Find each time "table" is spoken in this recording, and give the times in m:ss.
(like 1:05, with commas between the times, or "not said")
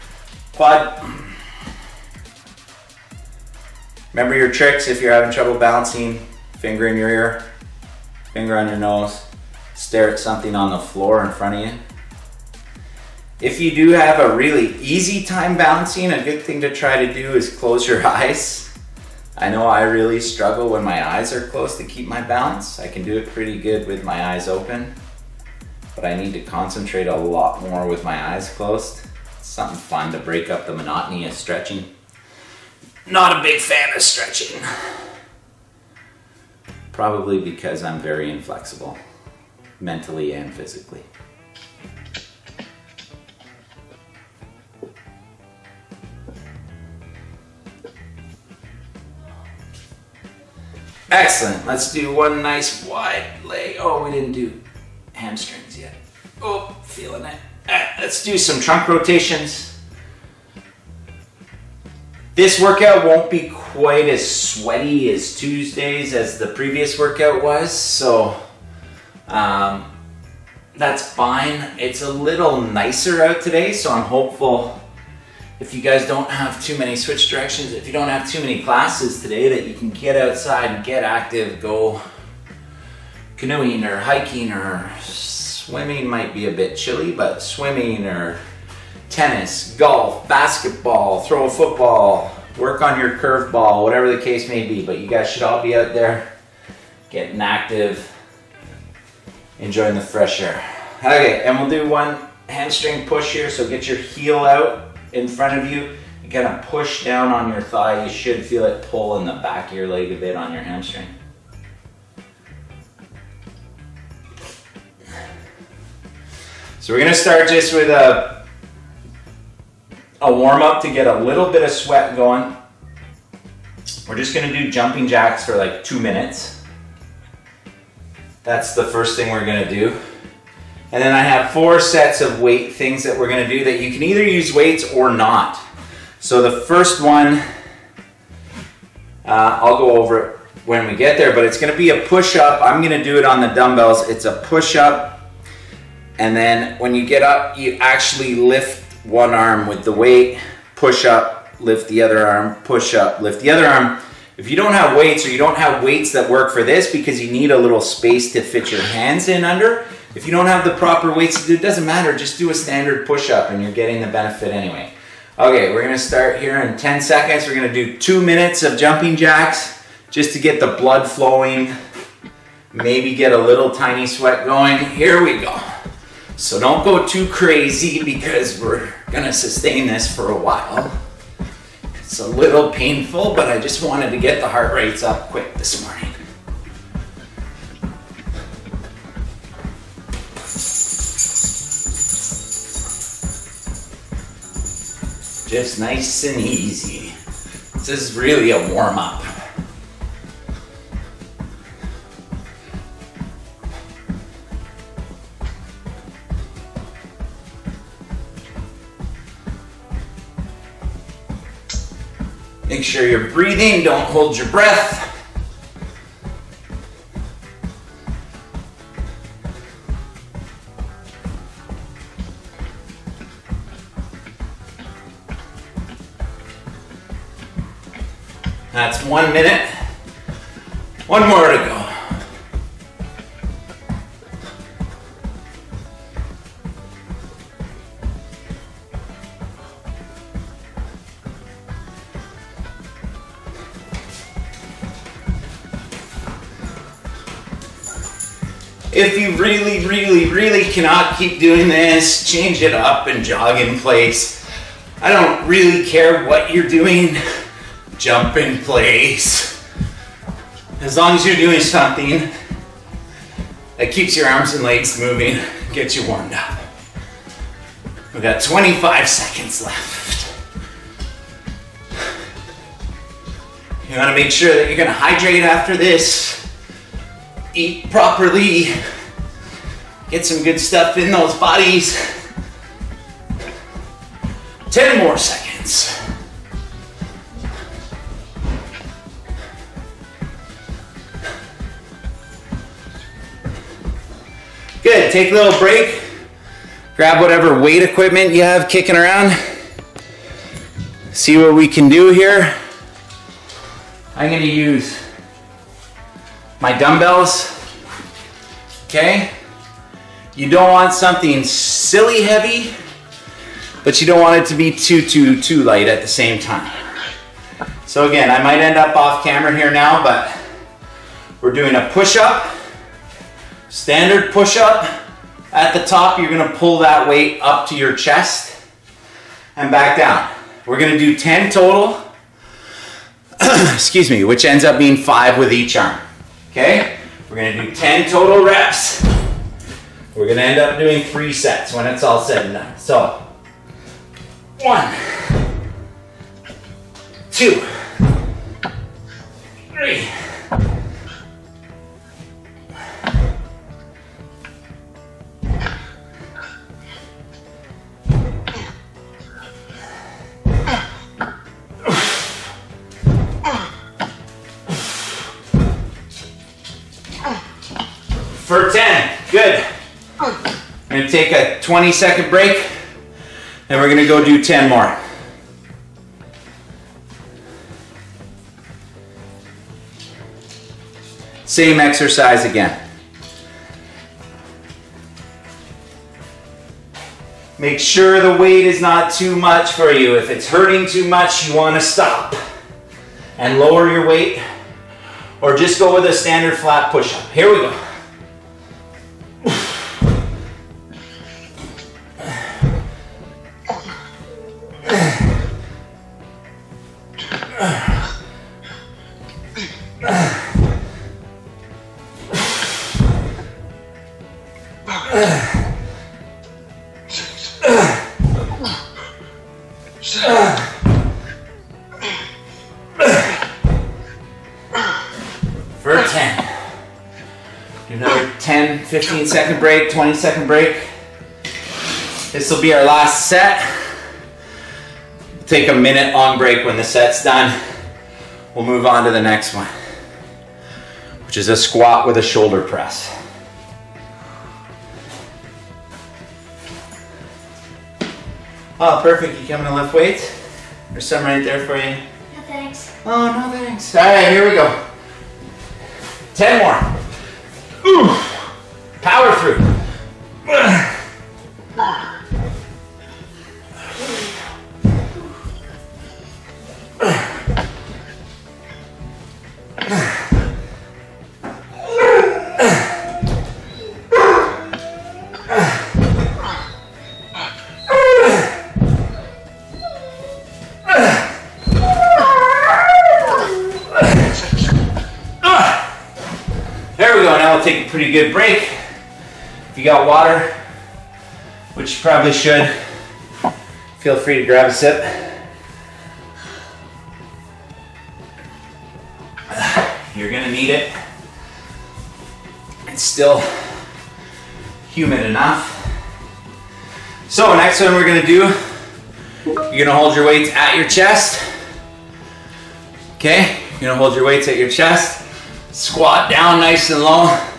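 not said.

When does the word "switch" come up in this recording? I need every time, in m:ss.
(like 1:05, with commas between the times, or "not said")
1:16.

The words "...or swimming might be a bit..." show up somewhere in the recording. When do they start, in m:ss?
1:24.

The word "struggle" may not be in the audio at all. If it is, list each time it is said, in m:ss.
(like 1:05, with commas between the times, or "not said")
0:20.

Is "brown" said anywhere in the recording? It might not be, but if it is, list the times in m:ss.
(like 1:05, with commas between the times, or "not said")
not said.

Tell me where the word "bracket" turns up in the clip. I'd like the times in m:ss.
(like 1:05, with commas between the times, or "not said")
not said.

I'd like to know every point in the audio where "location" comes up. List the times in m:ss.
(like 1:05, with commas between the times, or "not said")
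not said.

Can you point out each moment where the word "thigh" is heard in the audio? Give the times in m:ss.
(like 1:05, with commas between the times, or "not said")
1:47.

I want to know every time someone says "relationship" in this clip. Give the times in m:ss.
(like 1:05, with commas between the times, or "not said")
not said.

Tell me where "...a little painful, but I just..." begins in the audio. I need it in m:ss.
3:02.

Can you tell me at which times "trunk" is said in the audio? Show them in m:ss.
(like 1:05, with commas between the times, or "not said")
0:58.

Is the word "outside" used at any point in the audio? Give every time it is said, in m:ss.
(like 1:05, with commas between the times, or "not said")
1:20.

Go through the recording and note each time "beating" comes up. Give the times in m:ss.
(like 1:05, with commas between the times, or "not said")
not said.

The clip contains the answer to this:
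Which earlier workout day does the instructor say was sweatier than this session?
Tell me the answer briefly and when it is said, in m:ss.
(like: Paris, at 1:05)
Tuesday, at 1:05.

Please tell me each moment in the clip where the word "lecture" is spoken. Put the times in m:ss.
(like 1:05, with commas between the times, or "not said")
not said.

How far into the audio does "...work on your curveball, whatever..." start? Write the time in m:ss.
1:32.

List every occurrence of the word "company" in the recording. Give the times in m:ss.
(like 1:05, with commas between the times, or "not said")
not said.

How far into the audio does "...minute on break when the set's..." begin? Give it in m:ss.
7:15.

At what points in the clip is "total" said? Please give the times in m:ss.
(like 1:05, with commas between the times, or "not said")
5:31, 5:38.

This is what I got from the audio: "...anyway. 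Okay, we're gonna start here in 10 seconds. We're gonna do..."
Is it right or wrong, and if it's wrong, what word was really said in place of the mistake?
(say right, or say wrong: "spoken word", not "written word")
right.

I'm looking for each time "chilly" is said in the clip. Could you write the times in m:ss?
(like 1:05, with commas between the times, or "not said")
1:26.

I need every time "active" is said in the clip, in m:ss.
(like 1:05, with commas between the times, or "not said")
1:21, 1:37.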